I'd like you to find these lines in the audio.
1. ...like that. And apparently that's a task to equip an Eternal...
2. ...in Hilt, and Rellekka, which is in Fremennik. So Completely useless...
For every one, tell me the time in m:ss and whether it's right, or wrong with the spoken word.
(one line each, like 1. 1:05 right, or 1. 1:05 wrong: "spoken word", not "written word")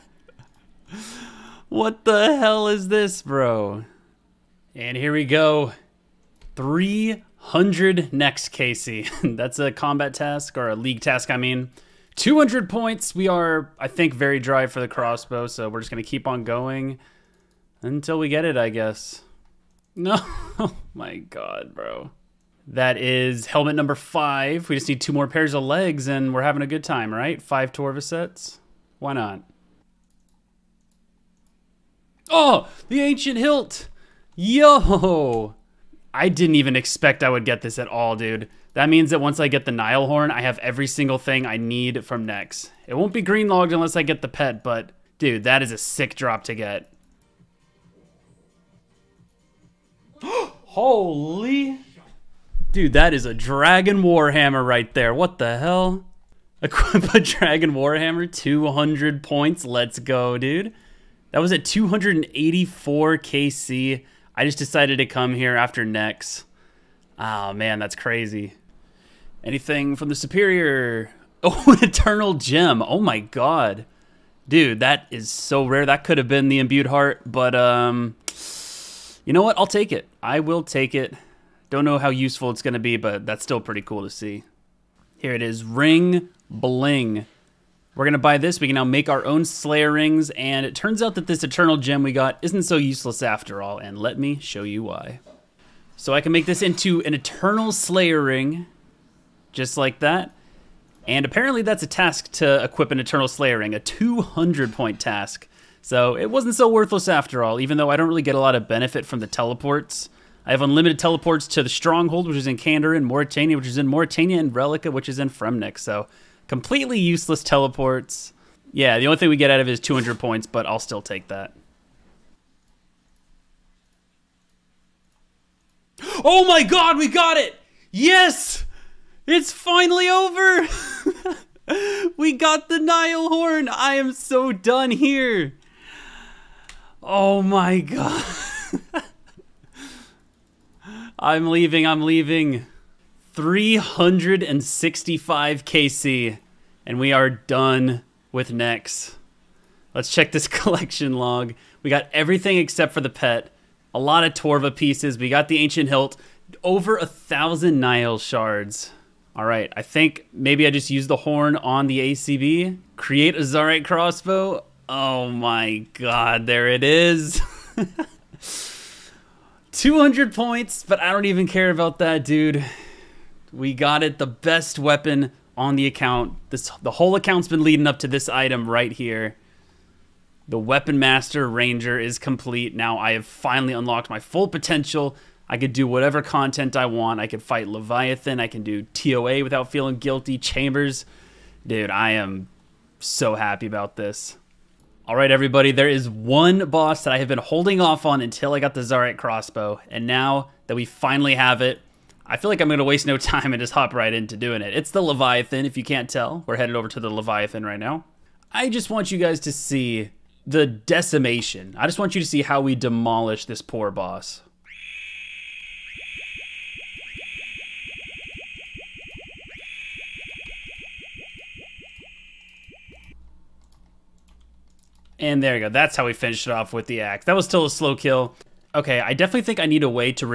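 1. 1:39 right
2. 1:53 wrong: "Morytania", not "Hilt".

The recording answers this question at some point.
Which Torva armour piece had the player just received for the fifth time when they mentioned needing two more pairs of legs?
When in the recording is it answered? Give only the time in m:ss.
0:23.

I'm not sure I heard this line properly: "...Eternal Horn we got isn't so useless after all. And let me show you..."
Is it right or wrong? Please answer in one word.
wrong.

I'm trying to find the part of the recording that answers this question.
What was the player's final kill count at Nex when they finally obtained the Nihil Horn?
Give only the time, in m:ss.
2:23.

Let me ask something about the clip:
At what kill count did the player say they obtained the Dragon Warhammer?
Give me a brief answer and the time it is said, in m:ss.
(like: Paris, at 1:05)
284, at 1:01.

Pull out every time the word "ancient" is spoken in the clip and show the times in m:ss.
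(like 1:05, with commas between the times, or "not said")
0:32, 2:35.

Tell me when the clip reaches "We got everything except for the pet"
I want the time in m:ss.
2:31.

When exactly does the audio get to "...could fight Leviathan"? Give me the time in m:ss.
3:07.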